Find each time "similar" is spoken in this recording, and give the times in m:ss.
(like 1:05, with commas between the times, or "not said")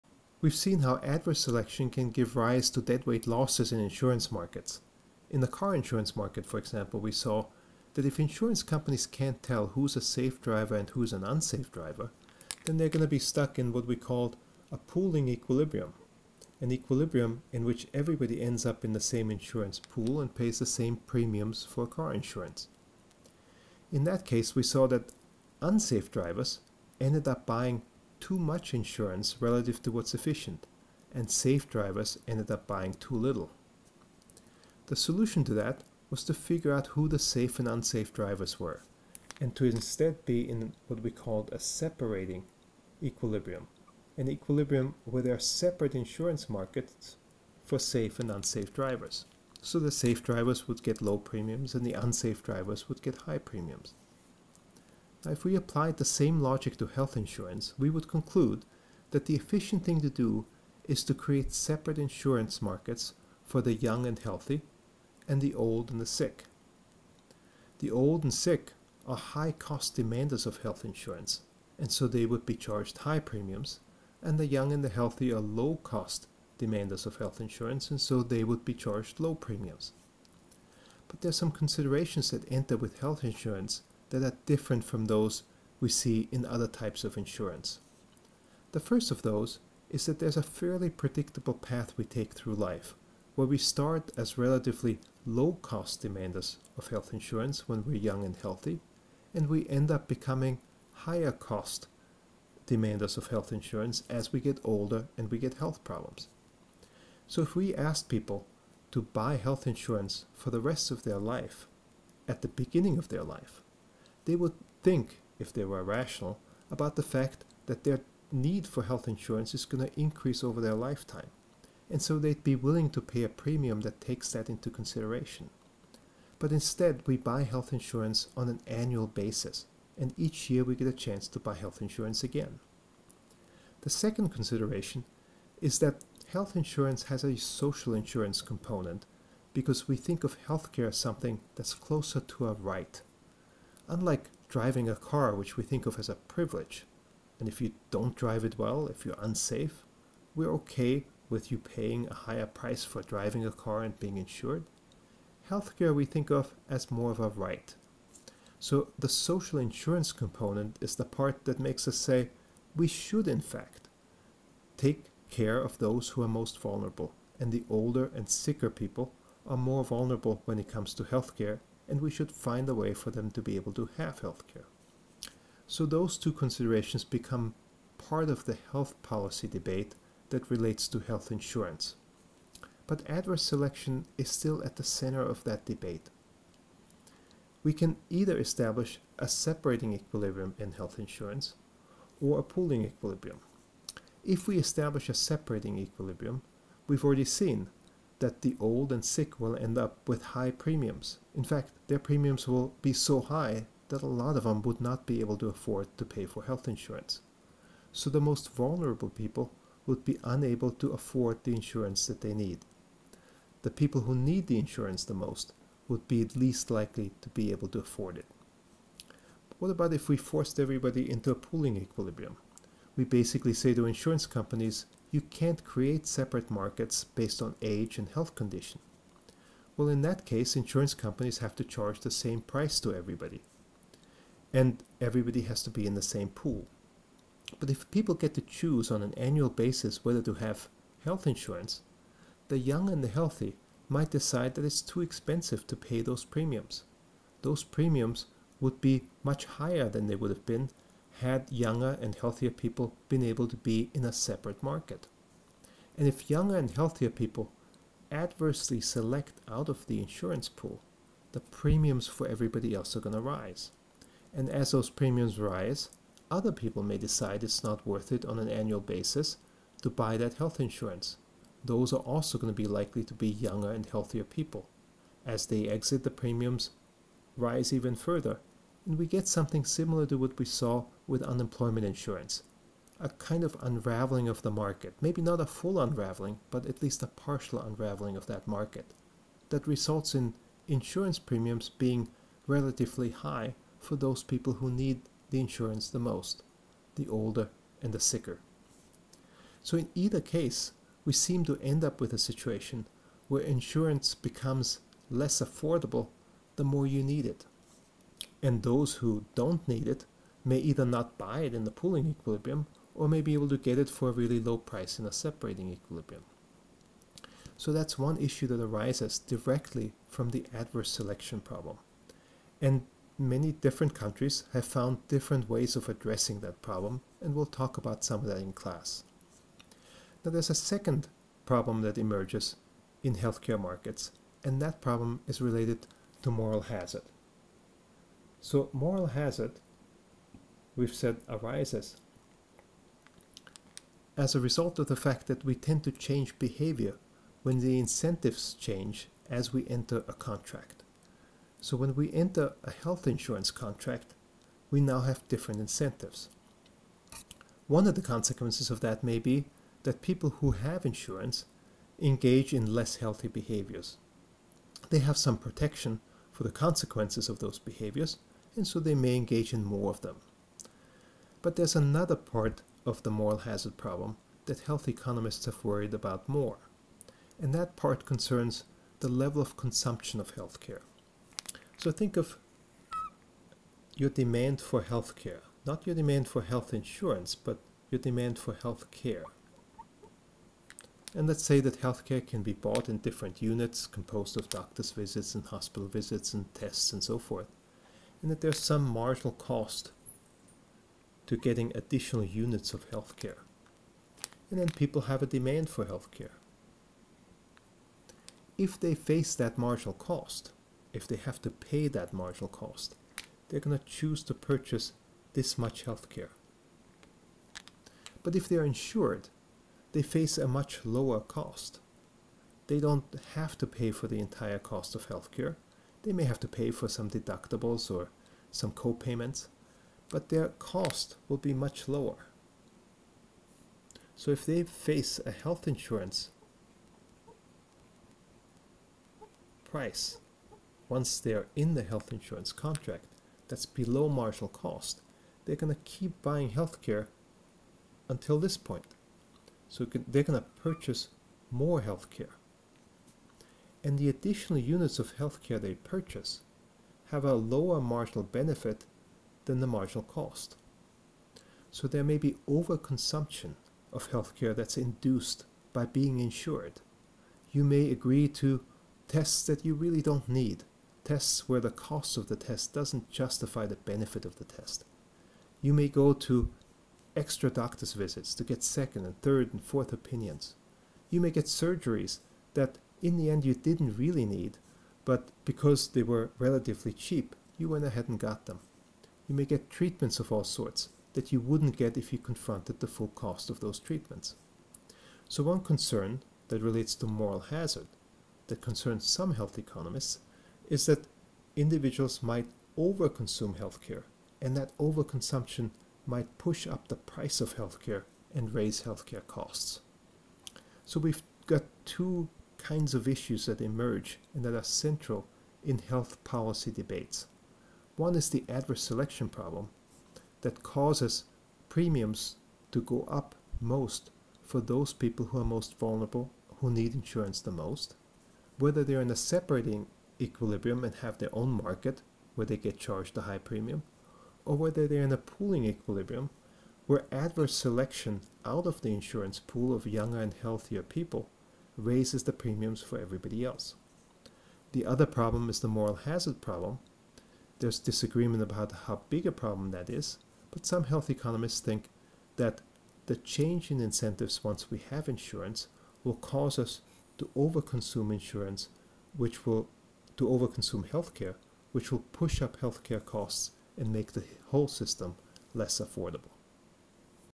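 4:39.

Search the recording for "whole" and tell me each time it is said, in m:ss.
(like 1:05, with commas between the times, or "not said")
9:24.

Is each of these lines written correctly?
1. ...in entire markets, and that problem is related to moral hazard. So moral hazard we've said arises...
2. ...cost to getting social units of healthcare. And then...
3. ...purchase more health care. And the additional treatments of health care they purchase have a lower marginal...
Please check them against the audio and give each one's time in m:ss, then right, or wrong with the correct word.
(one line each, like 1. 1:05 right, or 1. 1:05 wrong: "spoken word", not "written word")
1. 5:33 wrong: "healthcare", not "entire"
2. 6:39 wrong: "additional", not "social"
3. 7:30 wrong: "units", not "treatments".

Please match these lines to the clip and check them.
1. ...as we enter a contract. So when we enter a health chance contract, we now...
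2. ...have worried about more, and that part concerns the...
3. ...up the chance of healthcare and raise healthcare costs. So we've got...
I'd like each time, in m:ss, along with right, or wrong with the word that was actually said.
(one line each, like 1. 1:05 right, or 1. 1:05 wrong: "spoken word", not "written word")
1. 5:49 wrong: "insurance", not "chance"
2. 6:15 right
3. 8:26 wrong: "price", not "chance".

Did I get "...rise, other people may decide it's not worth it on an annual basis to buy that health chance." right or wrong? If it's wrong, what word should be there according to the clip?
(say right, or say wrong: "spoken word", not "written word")
wrong: "insurance", not "chance".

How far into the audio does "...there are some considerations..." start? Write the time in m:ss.
1:21.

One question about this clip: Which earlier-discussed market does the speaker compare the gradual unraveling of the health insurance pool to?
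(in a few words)
unemployment insurance.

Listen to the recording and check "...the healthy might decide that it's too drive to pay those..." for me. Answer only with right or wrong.
wrong.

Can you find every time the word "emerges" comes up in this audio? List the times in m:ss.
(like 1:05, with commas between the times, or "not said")
5:31, 8:33.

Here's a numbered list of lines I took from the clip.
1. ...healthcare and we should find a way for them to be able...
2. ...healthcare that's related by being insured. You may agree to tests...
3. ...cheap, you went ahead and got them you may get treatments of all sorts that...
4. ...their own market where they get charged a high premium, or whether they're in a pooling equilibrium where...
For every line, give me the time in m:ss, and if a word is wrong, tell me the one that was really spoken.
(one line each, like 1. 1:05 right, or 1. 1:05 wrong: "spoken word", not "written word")
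1. 2:51 right
2. 7:44 wrong: "induced", not "related"
3. 8:06 right
4. 8:51 right.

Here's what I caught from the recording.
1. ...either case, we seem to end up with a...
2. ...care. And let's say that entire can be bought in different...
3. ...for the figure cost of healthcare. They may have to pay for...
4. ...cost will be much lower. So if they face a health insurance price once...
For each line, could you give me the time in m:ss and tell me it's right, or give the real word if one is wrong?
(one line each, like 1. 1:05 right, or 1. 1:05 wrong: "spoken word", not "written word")
1. 4:59 right
2. 6:28 wrong: "healthcare", not "entire"
3. 7:03 wrong: "entire", not "figure"
4. 7:10 right.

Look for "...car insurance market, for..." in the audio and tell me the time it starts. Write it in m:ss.
0:05.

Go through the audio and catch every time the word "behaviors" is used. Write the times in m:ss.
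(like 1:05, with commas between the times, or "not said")
5:46, 6:03, 6:07.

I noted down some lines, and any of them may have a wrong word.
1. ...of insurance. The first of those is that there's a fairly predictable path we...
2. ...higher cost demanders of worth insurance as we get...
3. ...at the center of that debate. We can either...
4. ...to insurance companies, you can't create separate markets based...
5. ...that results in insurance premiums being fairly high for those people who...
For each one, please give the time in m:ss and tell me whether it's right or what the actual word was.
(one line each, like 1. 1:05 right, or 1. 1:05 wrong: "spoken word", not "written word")
1. 1:27 right
2. 1:40 wrong: "health", not "worth"
3. 3:04 right
4. 3:43 right
5. 4:49 wrong: "relatively", not "fairly".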